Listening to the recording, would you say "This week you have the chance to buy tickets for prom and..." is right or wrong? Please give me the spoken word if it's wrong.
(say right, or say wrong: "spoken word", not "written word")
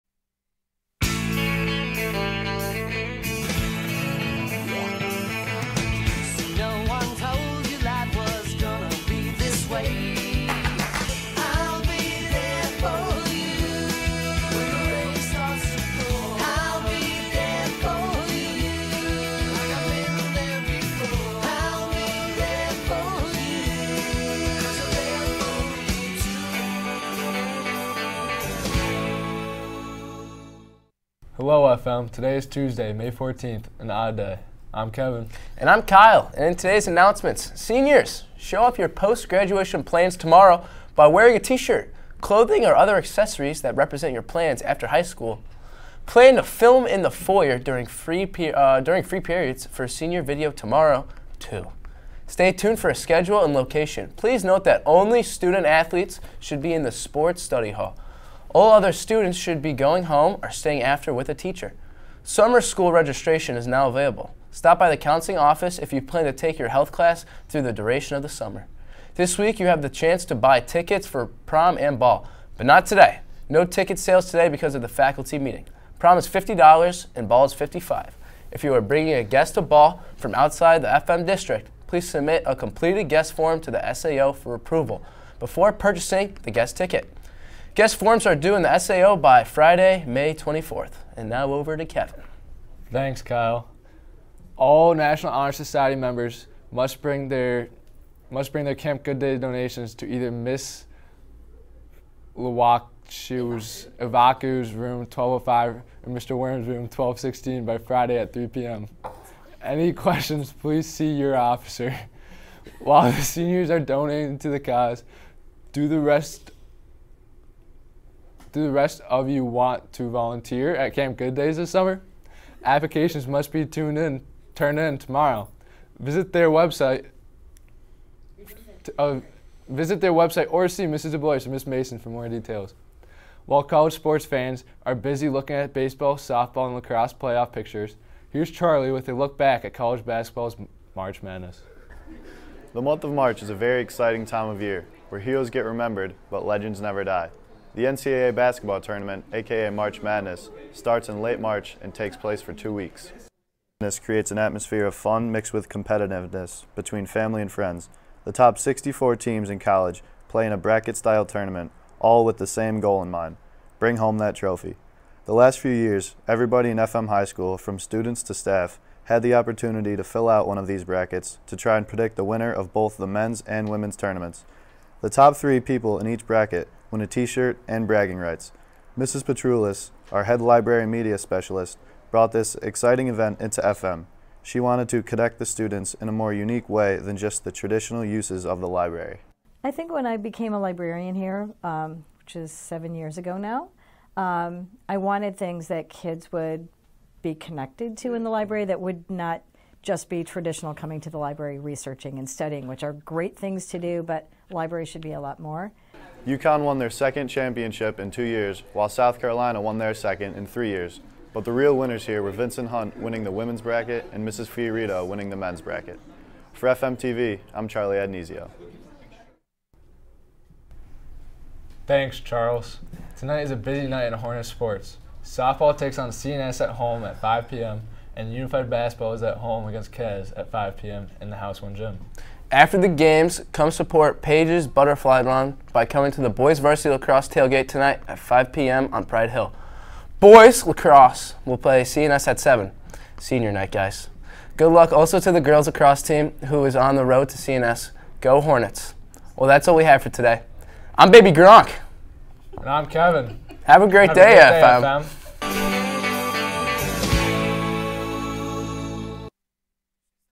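right.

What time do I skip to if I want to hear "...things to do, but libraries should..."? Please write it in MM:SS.
03:23.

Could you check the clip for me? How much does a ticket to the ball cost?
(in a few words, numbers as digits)
$55.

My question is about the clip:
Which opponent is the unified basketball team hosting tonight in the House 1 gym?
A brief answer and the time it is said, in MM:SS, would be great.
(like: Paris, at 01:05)
Kez, at 03:49.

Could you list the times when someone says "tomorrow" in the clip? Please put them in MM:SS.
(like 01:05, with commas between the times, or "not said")
00:40, 00:50, 02:04.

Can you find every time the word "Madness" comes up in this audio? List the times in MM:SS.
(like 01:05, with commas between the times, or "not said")
02:21, 02:30.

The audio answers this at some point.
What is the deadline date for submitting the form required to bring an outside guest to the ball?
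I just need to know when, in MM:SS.
01:29.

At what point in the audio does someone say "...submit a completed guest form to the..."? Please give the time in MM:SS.
01:22.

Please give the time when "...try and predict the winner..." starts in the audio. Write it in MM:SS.
02:51.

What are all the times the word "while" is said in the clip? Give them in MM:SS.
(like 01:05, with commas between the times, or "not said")
01:52, 02:13, 03:28.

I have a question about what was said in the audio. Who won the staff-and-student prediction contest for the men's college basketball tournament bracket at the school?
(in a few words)
Mrs. Fiorito.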